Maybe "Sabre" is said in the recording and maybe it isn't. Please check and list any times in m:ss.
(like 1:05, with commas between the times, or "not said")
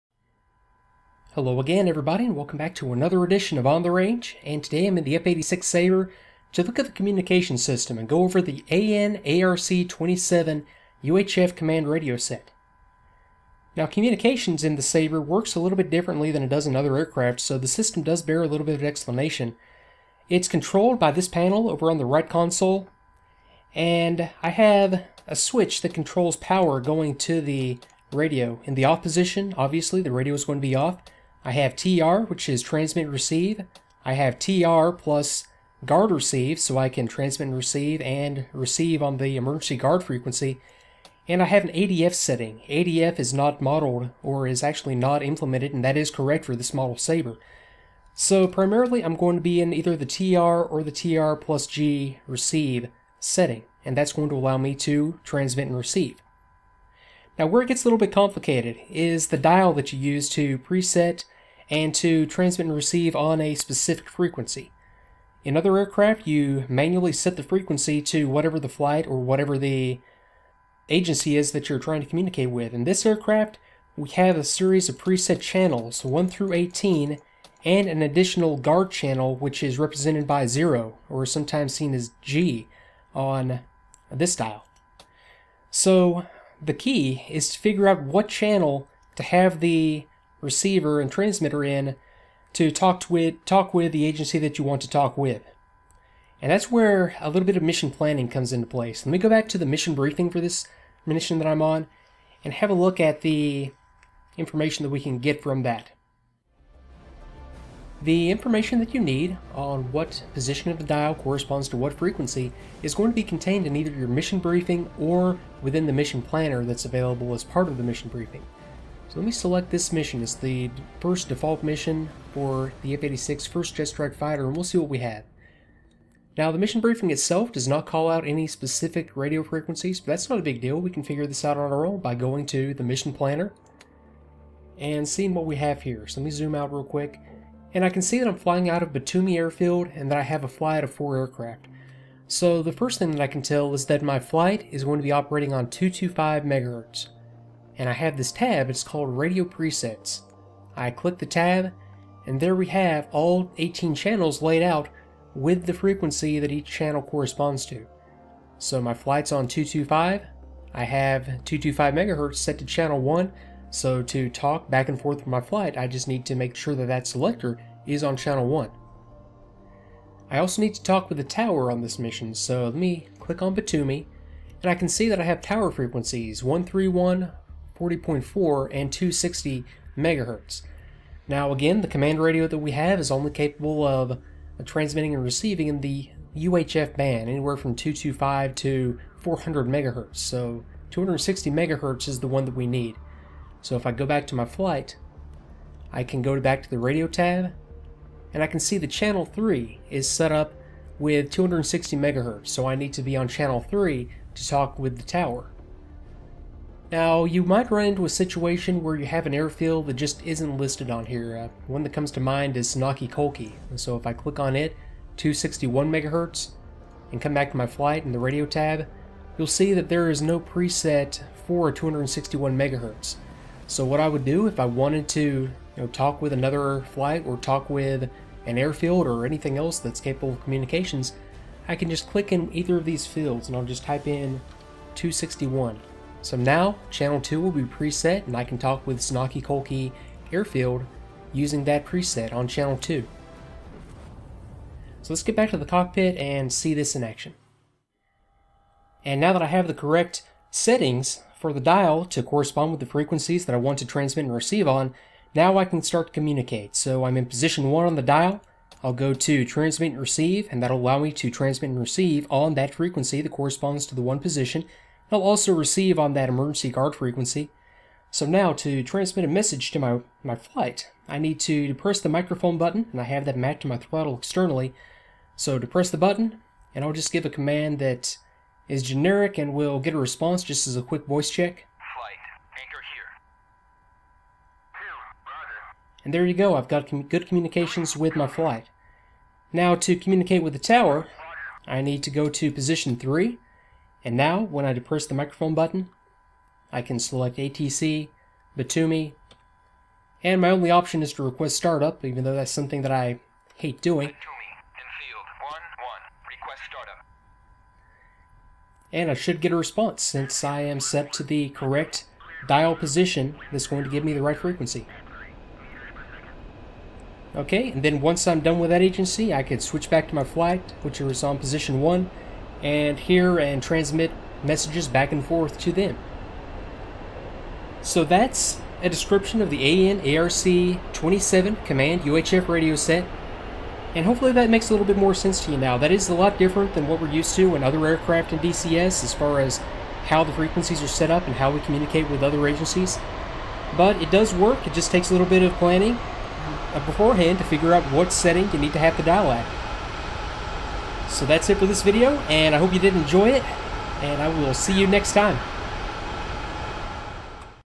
0:05, 0:14, 0:46.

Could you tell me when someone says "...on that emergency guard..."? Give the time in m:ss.
4:25.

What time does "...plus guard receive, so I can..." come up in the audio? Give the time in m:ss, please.
0:34.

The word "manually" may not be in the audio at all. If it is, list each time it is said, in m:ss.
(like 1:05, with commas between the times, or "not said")
1:06.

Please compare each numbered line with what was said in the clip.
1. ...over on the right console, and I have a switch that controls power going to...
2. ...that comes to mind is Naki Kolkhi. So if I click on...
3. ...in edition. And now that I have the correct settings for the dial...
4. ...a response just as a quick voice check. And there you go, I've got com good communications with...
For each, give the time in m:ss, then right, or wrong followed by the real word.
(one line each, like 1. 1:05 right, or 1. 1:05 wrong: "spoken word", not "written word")
1. 0:21 right
2. 3:31 right
3. 4:06 wrong: "action", not "edition"
4. 4:39 right.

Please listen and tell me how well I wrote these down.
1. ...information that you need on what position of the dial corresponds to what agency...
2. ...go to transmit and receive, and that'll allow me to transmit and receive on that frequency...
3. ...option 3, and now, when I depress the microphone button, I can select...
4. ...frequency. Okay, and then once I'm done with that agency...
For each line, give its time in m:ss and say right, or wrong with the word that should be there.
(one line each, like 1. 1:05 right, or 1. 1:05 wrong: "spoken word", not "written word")
1. 1:48 wrong: "frequency", not "agency"
2. 4:18 right
3. 4:52 wrong: "position", not "option"
4. 5:14 right.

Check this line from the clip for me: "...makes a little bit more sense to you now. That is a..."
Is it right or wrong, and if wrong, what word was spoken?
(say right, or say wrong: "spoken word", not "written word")
right.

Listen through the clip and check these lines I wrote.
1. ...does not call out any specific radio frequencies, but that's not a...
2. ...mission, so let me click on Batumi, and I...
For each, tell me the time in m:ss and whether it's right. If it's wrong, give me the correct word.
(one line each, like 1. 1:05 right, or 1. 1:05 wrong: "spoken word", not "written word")
1. 2:07 right
2. 2:51 right.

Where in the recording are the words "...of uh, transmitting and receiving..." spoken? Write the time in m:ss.
3:03.